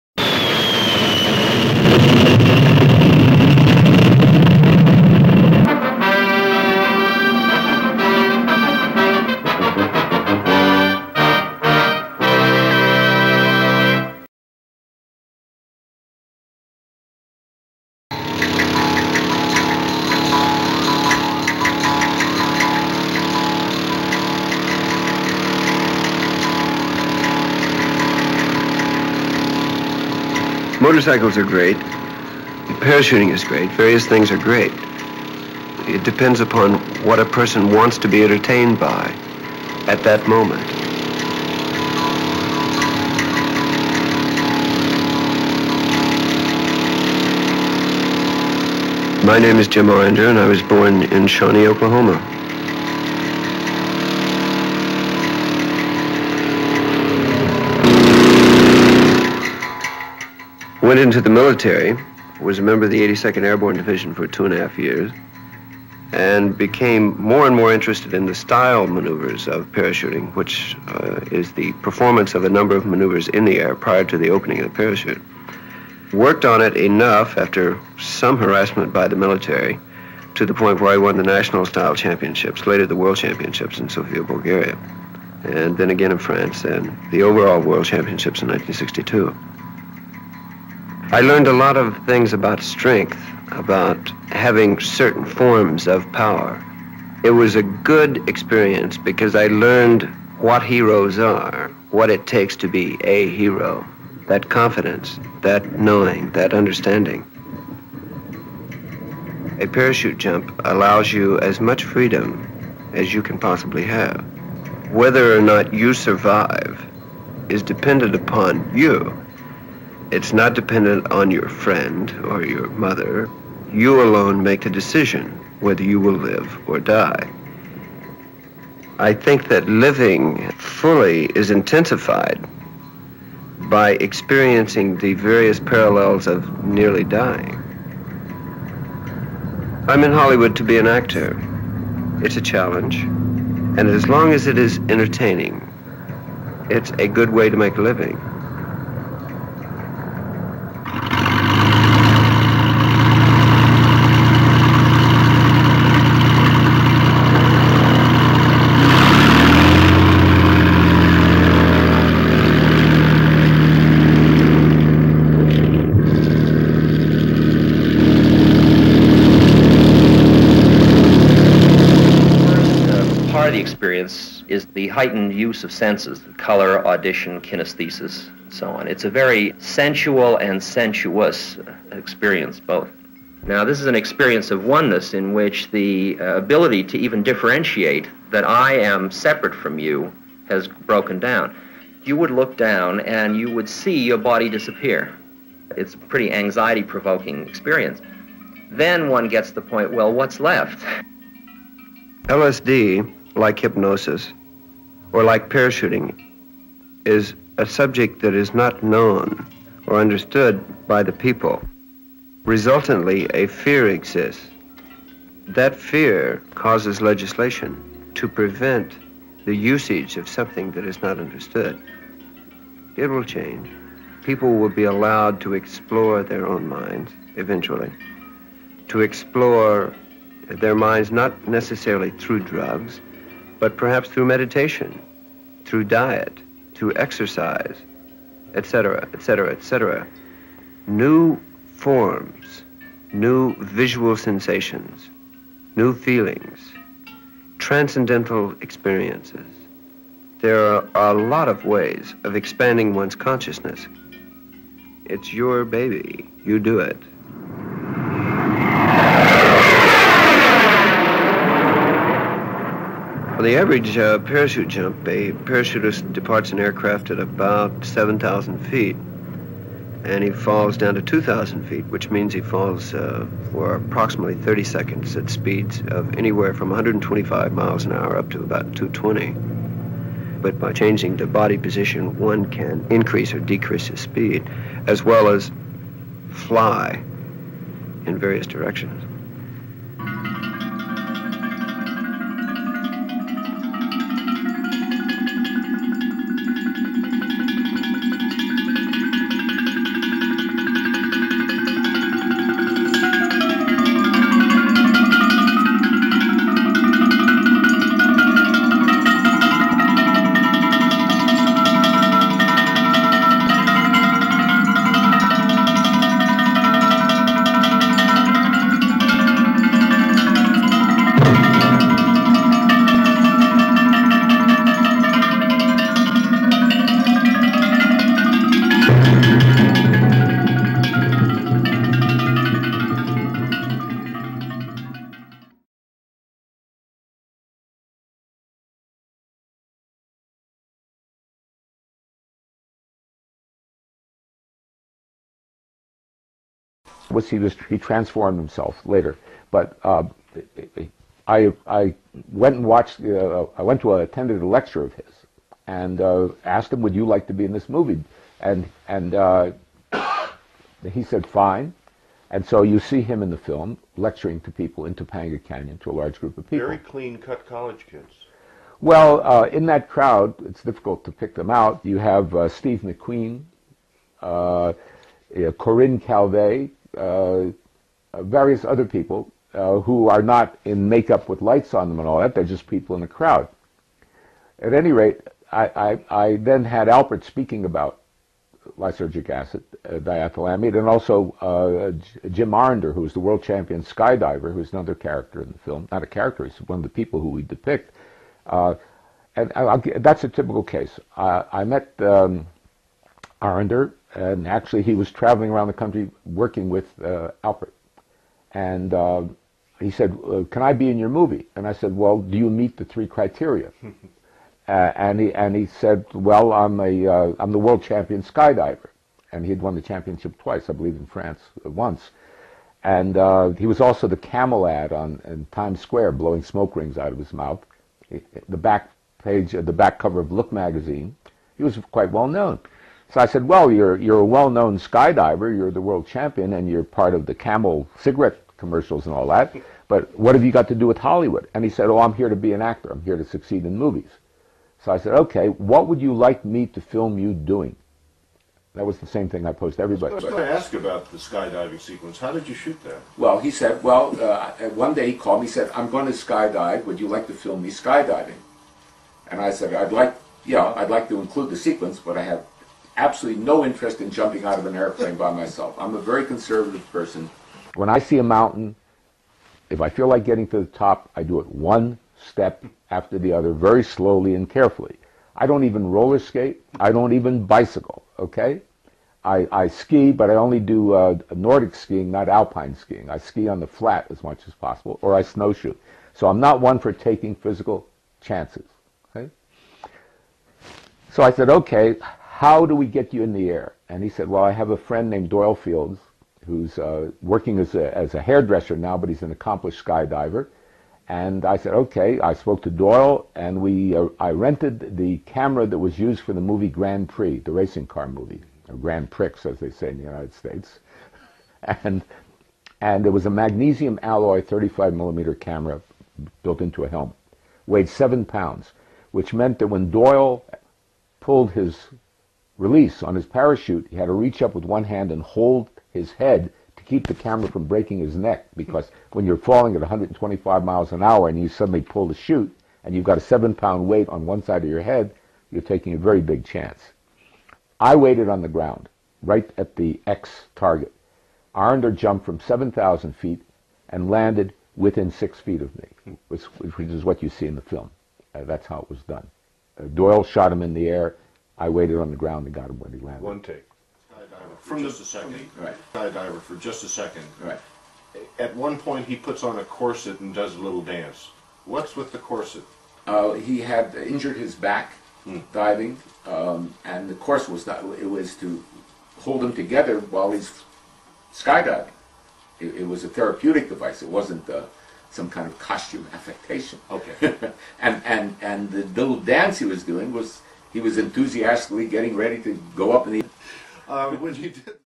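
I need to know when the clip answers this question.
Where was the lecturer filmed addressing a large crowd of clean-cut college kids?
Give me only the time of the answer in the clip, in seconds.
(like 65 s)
364 s.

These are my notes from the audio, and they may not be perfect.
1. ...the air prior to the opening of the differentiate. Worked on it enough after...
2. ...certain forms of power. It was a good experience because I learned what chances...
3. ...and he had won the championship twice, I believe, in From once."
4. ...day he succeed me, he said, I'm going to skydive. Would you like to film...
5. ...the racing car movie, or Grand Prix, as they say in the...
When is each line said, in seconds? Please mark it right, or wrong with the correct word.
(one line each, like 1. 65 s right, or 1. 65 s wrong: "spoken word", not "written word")
1. 73 s wrong: "parachute", not "differentiate"
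2. 94 s wrong: "heroes", not "chances"
3. 419 s wrong: "France", not "From"
4. 454 s wrong: "called", not "succeed"
5. 507 s right.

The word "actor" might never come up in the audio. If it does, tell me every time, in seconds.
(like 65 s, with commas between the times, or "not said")
140 s, 442 s.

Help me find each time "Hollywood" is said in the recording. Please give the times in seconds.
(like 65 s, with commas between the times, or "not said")
140 s, 440 s.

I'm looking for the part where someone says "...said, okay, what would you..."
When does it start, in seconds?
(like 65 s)
444 s.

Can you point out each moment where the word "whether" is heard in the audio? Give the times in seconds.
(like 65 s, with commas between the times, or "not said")
114 s, 125 s.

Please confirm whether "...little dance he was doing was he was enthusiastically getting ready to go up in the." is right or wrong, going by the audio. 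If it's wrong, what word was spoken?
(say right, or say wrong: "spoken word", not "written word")
right.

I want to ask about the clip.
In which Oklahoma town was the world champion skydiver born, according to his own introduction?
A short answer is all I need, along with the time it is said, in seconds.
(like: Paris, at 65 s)
Shawnee, at 51 s.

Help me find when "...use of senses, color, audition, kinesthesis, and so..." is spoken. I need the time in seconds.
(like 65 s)
175 s.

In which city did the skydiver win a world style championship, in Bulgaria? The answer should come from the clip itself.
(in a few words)
Sofia.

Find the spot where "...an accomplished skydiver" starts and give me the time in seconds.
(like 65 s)
499 s.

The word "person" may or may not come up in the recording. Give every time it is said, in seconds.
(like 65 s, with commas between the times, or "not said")
37 s, 466 s.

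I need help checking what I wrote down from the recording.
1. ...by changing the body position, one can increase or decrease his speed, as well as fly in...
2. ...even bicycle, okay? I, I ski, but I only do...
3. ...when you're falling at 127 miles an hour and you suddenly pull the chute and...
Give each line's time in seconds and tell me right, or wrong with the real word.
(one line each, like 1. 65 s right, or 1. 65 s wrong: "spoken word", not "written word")
1. 280 s right
2. 477 s right
3. 529 s wrong: "125", not "127".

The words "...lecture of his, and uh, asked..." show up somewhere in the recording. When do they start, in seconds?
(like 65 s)
354 s.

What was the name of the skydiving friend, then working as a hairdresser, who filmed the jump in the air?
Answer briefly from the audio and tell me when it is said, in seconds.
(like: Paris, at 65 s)
Doyle Fields, at 495 s.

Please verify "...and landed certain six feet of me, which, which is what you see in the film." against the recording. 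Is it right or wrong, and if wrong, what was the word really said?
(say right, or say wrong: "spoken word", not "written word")
wrong: "within", not "certain".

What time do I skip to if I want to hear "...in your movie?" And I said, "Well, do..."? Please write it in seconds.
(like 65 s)
410 s.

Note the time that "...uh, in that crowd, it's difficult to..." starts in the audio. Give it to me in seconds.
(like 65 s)
369 s.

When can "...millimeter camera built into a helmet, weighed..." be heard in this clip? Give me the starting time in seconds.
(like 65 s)
514 s.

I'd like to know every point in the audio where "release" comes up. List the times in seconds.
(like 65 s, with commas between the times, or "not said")
522 s.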